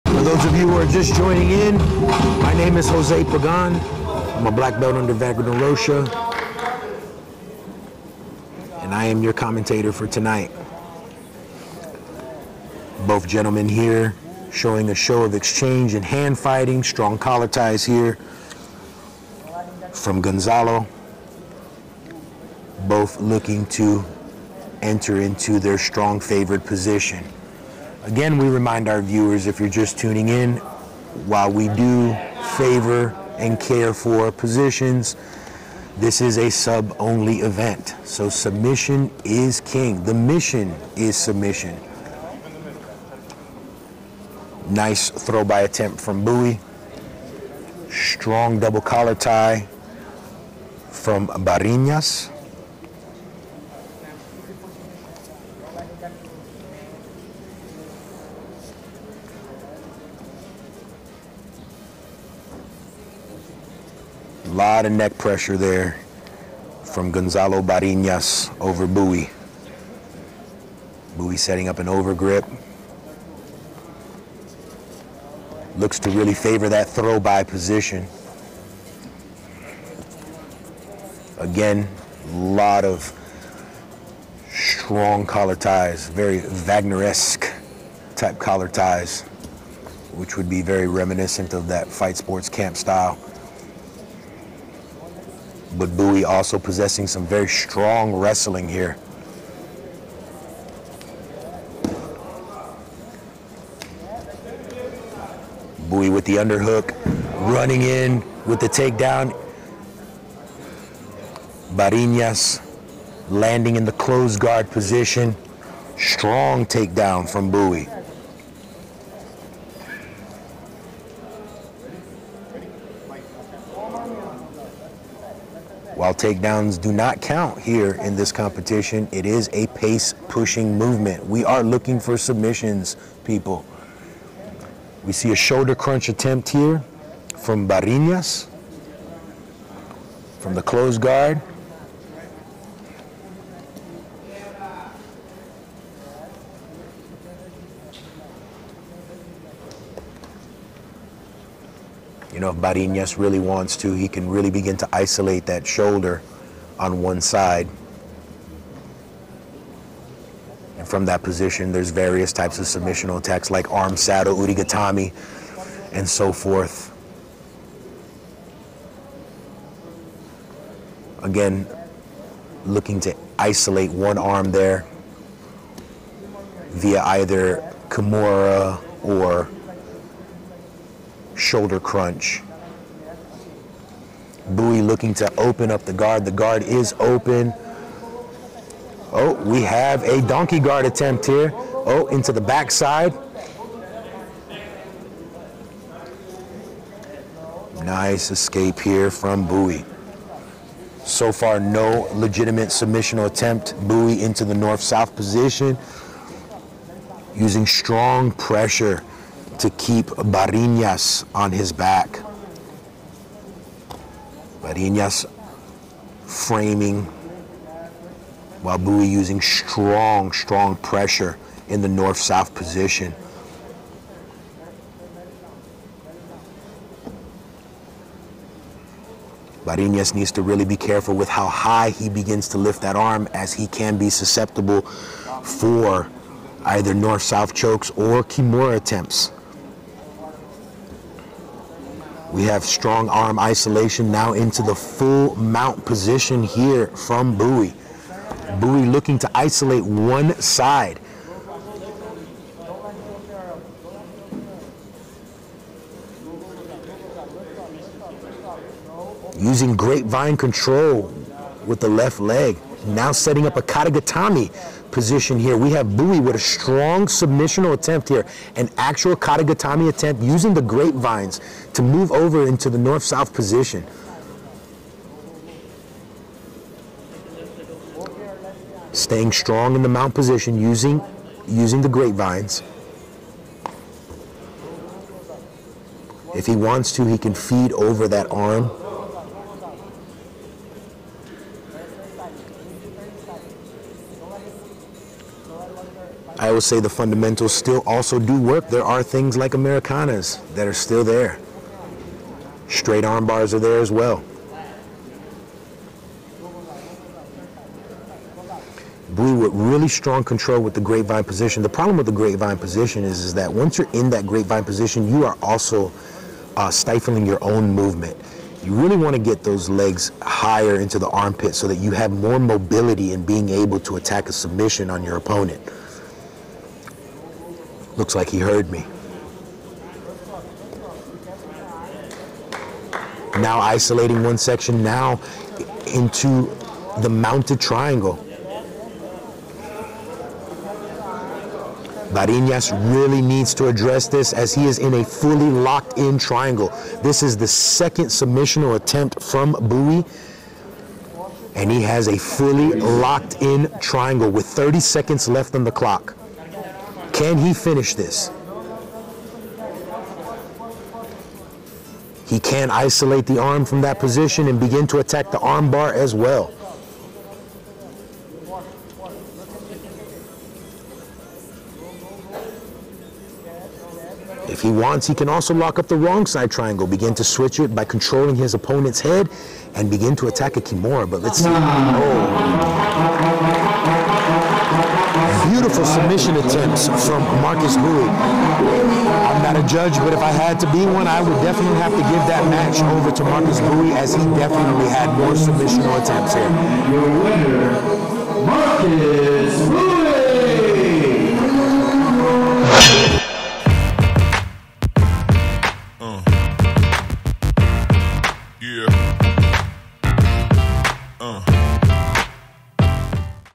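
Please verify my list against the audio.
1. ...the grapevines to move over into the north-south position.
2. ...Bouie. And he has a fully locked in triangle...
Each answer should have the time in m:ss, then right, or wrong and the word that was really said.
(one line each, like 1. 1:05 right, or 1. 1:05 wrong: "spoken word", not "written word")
1. 4:30 right
2. 5:49 right.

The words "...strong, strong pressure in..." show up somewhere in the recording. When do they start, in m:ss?
3:39.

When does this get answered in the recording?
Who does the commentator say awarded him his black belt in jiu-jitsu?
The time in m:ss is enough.
0:05.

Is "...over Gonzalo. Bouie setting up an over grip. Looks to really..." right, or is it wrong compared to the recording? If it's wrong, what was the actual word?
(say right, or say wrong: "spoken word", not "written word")
wrong: "Bouie", not "Gonzalo".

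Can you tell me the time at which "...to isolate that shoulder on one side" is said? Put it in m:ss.
2:34.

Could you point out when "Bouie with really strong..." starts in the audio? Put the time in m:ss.
5:09.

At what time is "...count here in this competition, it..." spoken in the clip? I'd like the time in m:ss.
2:07.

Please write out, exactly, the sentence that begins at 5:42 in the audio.
Ballinas really needs to address this as he is in a fully locked in triangle.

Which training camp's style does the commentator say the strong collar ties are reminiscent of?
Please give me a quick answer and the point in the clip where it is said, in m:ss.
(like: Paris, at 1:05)
Fight Sports, at 1:31.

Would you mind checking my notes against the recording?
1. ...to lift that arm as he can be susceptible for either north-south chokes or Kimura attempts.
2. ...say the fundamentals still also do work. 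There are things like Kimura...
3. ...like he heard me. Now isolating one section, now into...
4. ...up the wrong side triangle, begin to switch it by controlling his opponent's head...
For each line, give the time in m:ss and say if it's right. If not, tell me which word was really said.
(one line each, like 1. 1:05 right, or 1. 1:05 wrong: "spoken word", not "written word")
1. 3:52 right
2. 4:56 wrong: "Americanas", not "Kimura"
3. 5:28 right
4. 6:15 right.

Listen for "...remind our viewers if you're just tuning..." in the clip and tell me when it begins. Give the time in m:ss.
0:28.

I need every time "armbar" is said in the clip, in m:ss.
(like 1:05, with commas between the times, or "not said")
6:05.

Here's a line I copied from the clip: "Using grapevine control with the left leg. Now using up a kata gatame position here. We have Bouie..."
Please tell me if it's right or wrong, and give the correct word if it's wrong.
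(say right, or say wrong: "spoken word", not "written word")
wrong: "setting", not "using".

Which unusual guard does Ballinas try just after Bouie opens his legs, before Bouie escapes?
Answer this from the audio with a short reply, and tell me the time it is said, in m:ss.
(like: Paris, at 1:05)
Donkey guard, at 3:10.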